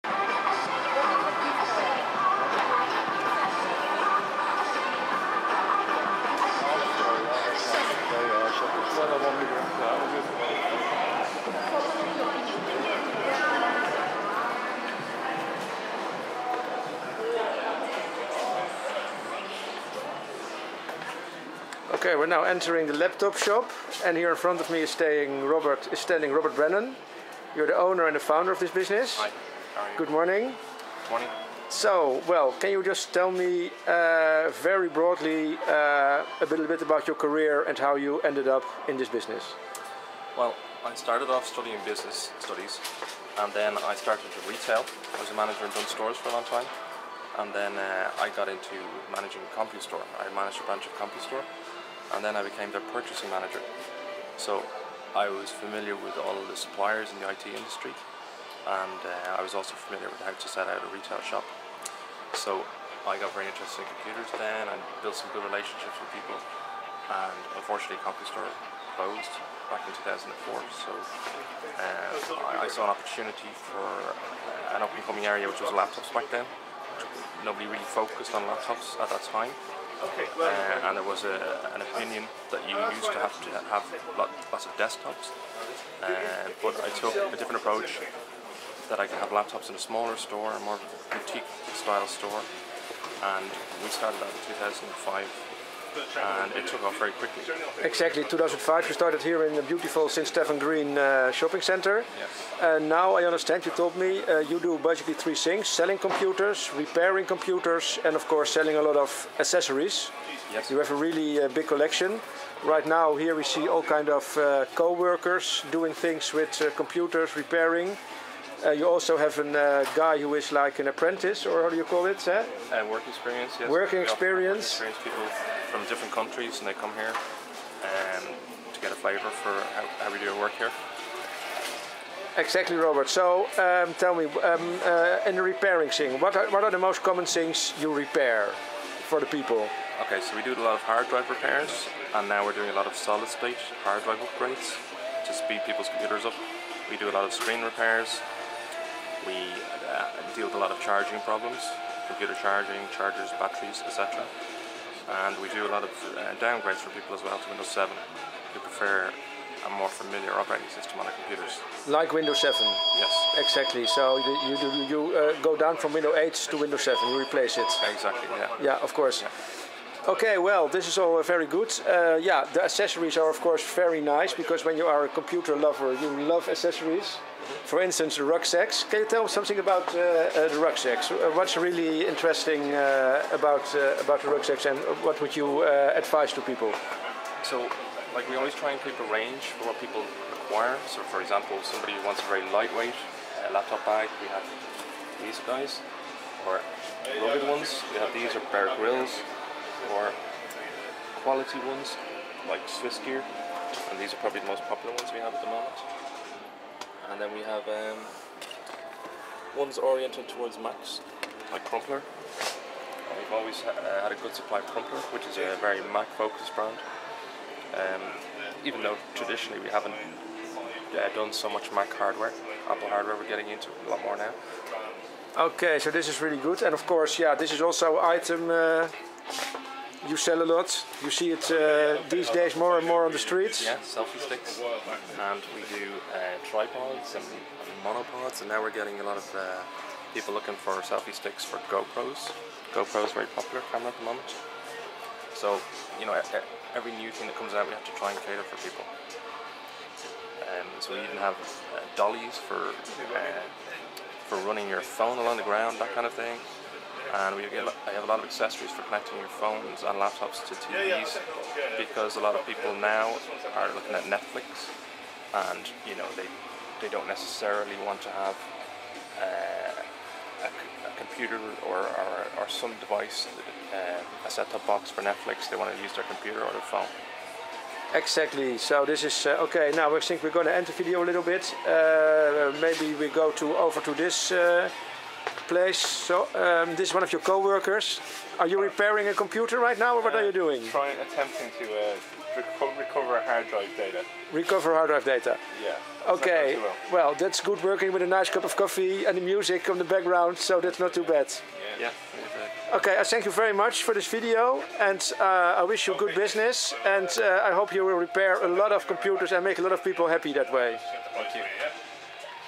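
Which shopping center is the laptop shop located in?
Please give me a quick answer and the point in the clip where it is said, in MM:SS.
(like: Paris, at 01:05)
St. Stephen's Green, at 01:40.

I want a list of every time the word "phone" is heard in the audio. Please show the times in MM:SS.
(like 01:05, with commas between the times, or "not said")
04:14, 04:19, 04:36.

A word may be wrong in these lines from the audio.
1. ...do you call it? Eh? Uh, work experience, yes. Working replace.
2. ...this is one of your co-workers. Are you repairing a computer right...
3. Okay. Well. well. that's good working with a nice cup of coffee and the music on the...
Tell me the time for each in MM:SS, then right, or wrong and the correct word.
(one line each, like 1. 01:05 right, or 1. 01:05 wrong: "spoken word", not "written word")
1. 02:01 wrong: "experience", not "replace"
2. 04:46 right
3. 04:56 right.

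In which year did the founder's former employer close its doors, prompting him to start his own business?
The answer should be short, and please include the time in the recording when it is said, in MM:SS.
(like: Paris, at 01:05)
2004, at 01:10.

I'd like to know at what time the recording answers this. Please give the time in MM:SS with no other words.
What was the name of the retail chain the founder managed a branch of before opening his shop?
01:08.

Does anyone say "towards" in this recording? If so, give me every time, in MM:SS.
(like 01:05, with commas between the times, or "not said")
03:30.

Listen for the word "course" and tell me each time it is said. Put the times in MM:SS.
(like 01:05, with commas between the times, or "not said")
01:48, 02:48, 02:53, 03:46.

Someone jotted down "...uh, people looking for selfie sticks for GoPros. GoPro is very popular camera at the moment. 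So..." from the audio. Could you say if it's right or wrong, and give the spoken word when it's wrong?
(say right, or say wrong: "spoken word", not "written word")
right.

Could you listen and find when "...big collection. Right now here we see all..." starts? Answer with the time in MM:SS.
01:51.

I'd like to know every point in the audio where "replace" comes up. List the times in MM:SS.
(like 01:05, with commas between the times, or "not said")
02:47.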